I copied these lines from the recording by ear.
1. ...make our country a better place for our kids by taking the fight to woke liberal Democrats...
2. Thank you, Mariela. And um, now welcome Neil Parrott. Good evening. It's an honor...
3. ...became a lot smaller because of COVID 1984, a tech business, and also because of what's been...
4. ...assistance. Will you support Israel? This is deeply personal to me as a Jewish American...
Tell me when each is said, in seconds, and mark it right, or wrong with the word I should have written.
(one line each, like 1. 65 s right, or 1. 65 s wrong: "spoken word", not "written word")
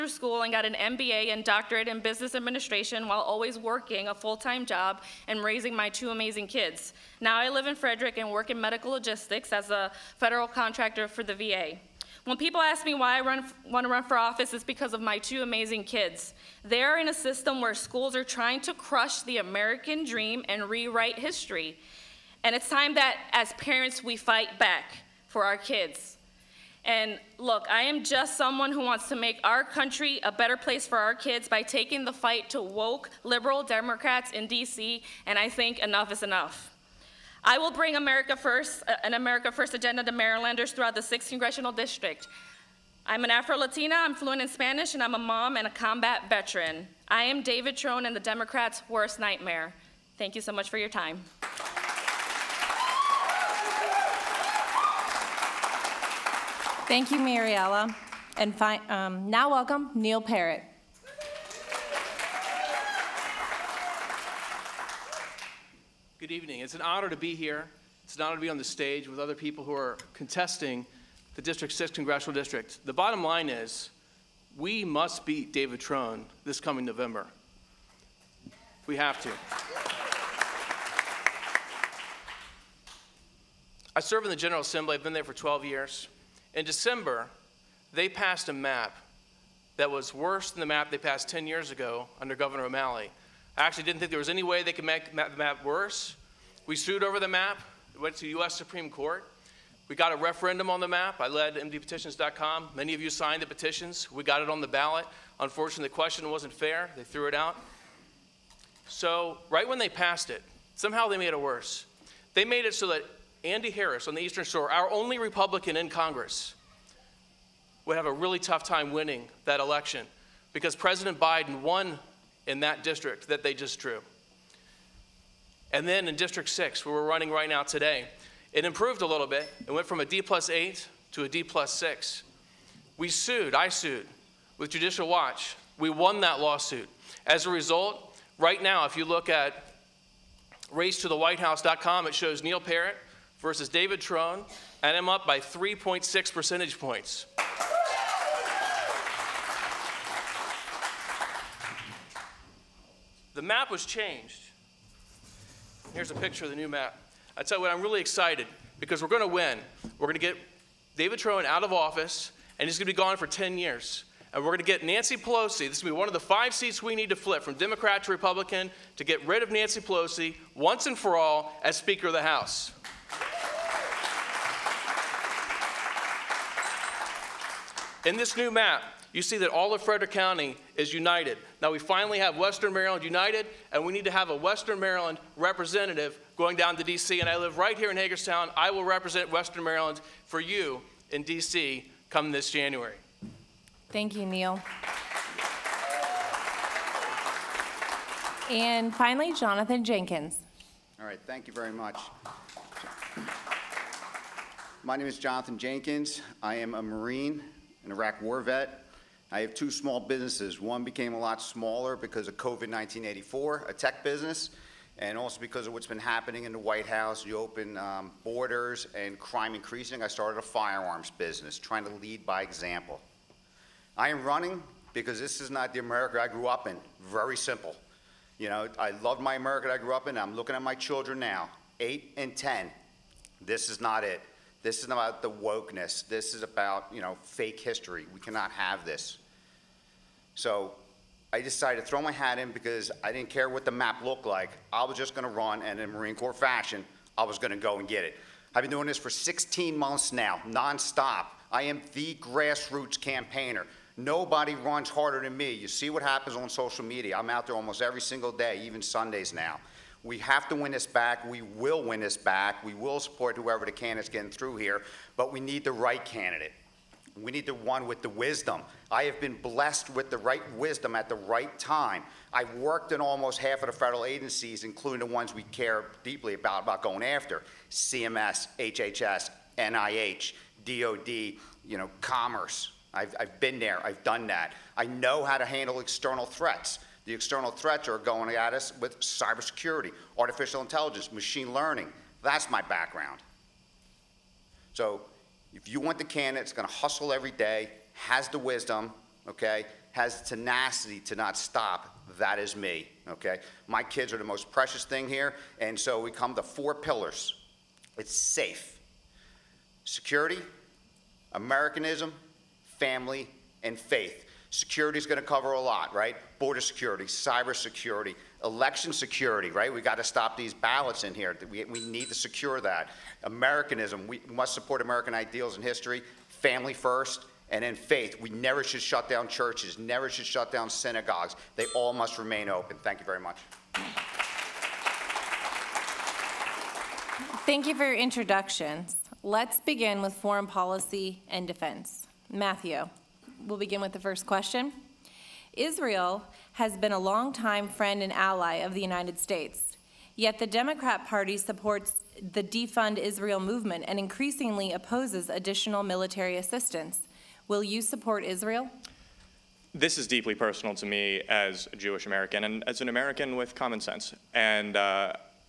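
1. 29 s right
2. 56 s right
3. 210 s right
4. 356 s right.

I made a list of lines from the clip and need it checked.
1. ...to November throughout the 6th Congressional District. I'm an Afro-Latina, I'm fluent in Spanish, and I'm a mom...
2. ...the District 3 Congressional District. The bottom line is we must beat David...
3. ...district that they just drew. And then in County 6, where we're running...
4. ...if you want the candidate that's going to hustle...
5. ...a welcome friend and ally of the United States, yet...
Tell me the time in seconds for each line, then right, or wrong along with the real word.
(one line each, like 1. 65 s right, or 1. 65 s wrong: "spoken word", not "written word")
1. 40 s wrong: "Marylanders", not "November"
2. 71 s wrong: "6", not "3"
3. 122 s wrong: "District", not "County"
4. 295 s right
5. 346 s wrong: "longtime", not "welcome".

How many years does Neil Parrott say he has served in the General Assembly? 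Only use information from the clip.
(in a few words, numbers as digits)
12.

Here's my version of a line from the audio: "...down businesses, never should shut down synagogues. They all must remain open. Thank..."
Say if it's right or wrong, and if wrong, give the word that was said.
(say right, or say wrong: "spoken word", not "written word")
wrong: "churches", not "businesses".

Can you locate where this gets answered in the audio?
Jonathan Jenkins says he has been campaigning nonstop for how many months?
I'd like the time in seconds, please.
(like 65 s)
249 s.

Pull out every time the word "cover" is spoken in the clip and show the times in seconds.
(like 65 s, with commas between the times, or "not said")
315 s.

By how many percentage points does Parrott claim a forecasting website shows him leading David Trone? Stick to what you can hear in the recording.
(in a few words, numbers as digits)
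3.6.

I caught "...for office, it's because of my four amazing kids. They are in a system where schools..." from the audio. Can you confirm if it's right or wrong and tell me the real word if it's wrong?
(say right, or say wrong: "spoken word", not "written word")
wrong: "two", not "four".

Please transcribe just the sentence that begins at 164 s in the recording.
And we're going to get Nancy Pelosi.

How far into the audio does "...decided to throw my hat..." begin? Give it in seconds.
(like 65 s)
241 s.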